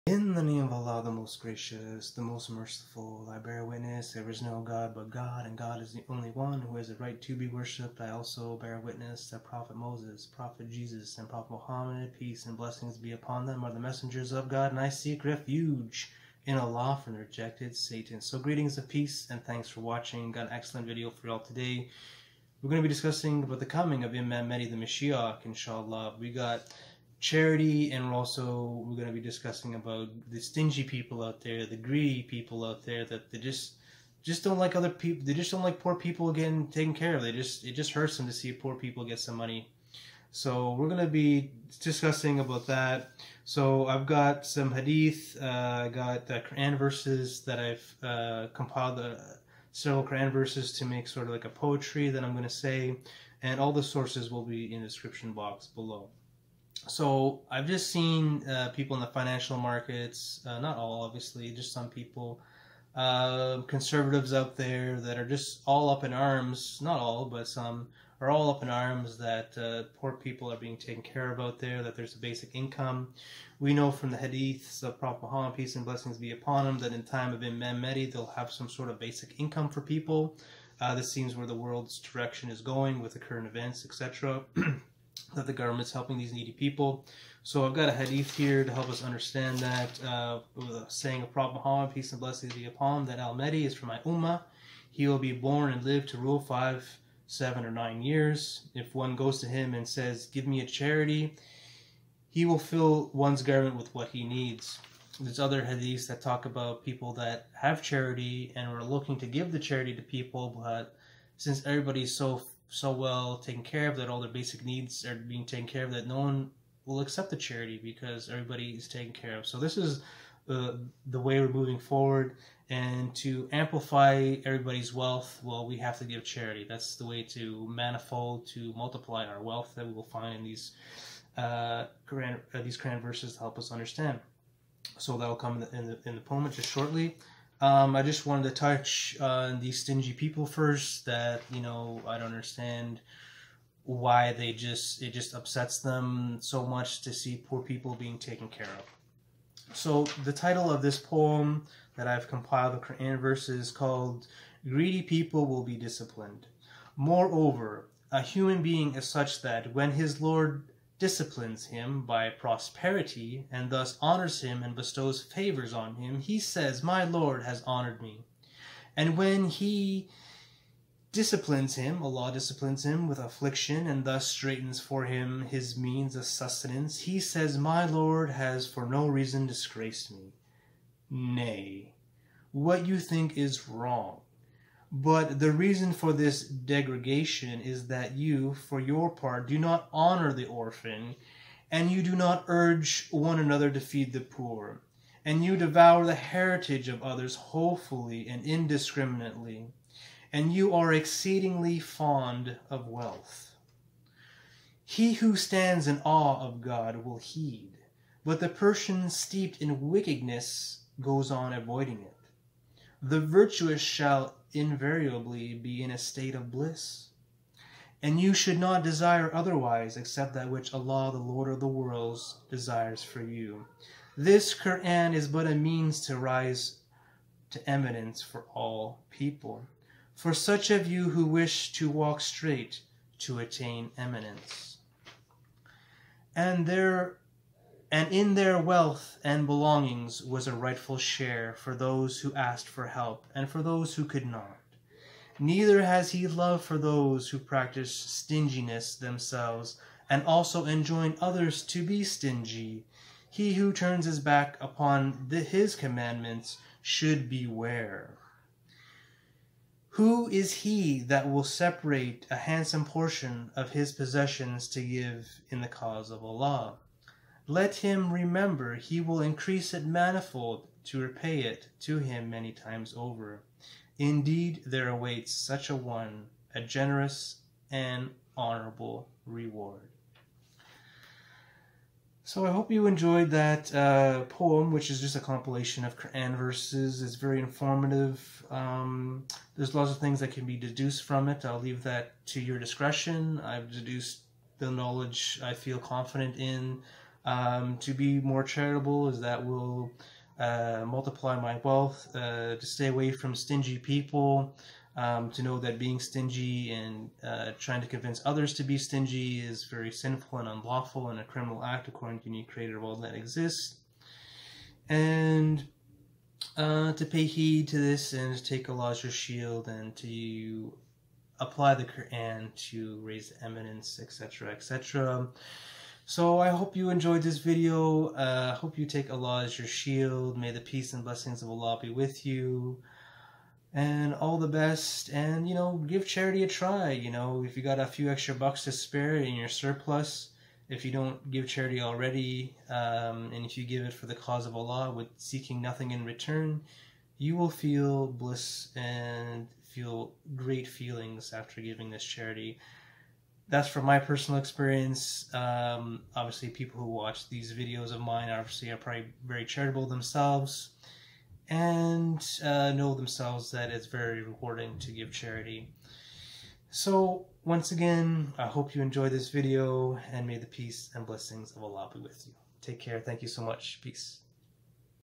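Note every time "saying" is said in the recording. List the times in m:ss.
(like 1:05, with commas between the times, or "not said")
1:30.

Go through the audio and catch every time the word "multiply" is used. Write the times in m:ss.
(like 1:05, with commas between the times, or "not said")
2:08, 5:00.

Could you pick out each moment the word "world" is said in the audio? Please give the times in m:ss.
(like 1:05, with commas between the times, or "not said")
1:21, 3:41.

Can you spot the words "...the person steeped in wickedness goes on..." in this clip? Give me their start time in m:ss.
3:28.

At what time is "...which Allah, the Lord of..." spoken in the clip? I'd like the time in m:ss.
3:40.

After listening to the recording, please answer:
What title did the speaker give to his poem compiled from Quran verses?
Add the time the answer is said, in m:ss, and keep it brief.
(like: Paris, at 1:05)
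Greedy People Will Be Disciplined, at 2:34.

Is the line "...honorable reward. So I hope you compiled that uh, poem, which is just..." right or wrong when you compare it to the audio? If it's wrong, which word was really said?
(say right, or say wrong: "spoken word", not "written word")
wrong: "enjoyed", not "compiled".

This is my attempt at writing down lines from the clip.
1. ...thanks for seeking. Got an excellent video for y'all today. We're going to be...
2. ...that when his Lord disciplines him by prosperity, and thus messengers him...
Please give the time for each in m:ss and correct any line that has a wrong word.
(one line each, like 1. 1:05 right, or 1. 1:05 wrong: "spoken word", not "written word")
1. 0:19 wrong: "watching", not "seeking"
2. 2:39 wrong: "honors", not "messengers".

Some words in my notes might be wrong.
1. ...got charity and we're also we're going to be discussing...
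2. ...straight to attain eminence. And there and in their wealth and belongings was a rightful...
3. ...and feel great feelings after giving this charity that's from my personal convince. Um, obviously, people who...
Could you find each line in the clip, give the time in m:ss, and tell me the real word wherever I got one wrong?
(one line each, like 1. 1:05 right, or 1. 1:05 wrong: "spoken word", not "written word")
1. 0:26 right
2. 3:52 right
3. 5:48 wrong: "experience", not "convince".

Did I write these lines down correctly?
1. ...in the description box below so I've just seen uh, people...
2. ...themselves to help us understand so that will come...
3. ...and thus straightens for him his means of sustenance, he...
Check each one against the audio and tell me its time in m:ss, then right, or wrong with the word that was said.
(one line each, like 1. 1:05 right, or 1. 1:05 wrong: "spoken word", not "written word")
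1. 0:54 right
2. 2:13 wrong: "verses", not "themselves"
3. 2:53 right.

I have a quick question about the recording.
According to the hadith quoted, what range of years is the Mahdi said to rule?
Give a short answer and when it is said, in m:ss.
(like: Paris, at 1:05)
5, 7, or 9 years, at 1:36.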